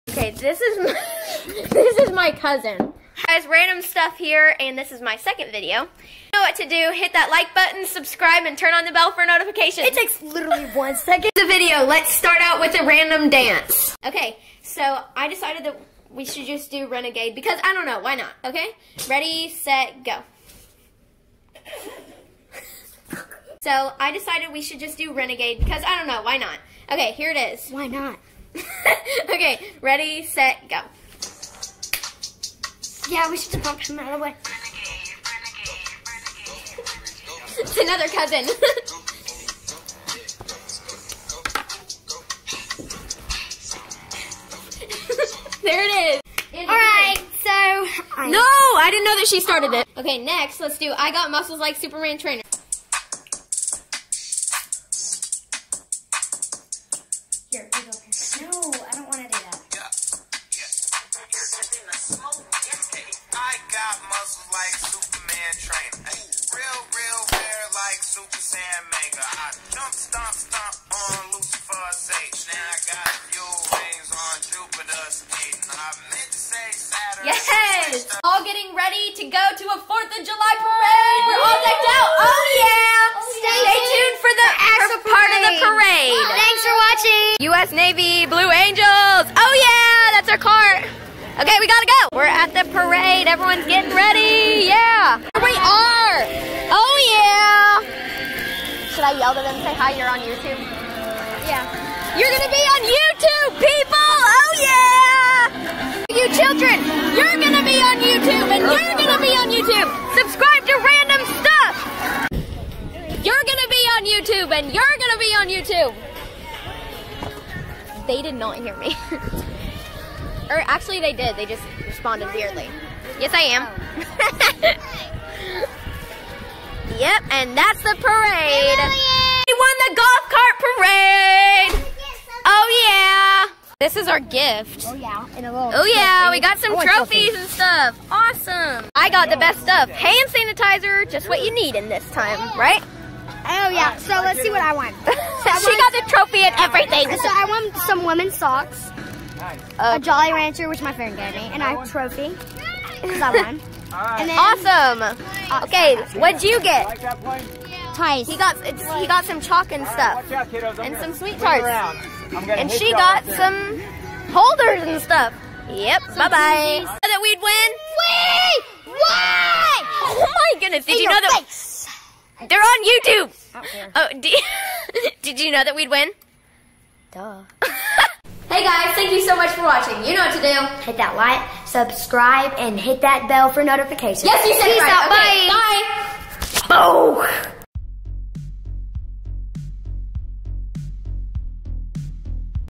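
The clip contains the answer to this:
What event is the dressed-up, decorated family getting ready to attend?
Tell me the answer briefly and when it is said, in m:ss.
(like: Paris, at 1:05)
4th of July parade, at 1:19.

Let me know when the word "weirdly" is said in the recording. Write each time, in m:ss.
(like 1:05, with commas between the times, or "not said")
2:02.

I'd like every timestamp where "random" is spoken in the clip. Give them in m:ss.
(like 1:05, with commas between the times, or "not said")
0:03, 0:12, 1:50.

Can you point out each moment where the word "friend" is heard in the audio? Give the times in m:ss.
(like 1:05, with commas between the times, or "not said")
2:30.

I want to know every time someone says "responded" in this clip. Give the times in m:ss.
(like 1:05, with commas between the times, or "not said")
2:01.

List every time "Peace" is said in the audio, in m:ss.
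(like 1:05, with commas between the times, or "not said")
3:04.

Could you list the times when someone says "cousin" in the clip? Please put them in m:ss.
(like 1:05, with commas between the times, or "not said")
0:02, 0:38.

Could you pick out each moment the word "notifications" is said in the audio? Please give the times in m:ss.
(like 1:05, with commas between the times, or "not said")
0:09, 3:03.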